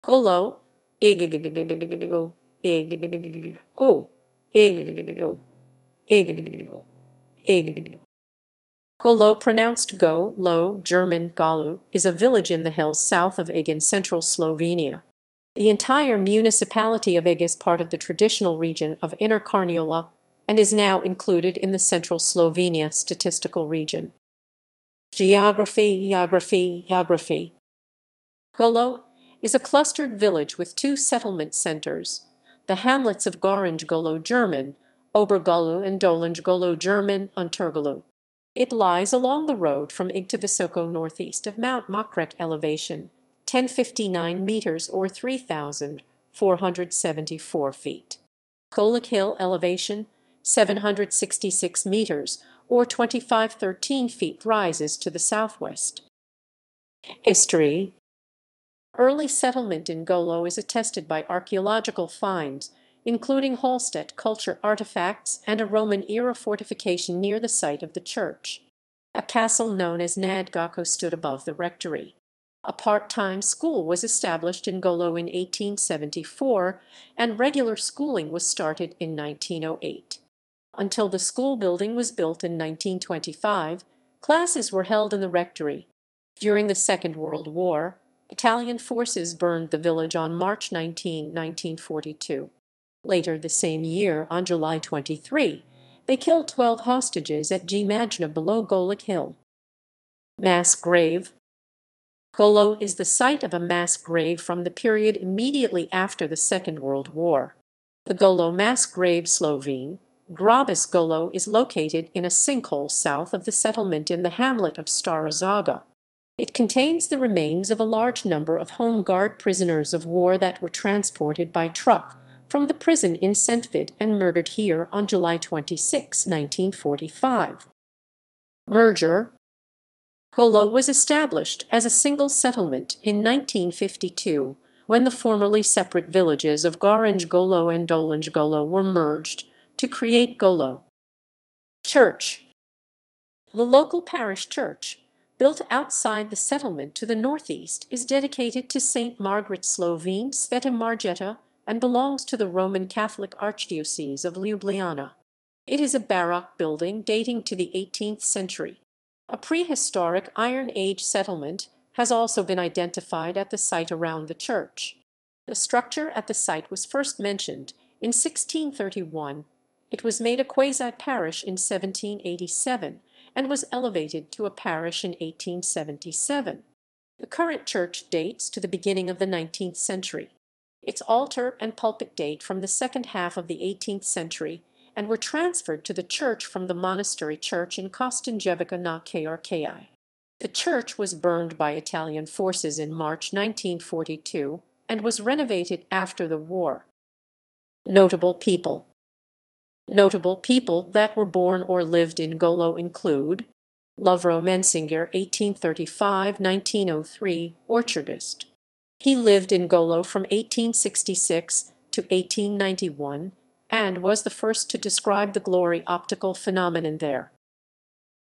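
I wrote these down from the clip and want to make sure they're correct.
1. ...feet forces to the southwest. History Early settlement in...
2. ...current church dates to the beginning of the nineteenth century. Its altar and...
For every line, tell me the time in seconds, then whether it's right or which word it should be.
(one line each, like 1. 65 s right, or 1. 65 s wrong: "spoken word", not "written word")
1. 54 s wrong: "rises", not "forces"
2. 177 s right.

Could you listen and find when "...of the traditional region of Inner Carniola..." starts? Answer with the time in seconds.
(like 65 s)
17 s.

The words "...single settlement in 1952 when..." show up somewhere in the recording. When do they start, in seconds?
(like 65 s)
131 s.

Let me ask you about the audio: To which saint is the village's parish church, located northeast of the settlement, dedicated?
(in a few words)
St. Margaret.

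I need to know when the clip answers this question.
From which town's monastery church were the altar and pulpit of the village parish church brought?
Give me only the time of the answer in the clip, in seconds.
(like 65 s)
187 s.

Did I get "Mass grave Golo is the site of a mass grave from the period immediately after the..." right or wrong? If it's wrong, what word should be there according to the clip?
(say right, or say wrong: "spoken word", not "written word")
right.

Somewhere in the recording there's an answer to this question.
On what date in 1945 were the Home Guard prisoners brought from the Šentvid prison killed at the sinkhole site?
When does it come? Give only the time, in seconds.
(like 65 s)
125 s.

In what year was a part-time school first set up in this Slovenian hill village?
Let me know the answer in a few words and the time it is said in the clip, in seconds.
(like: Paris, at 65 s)
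1874, at 75 s.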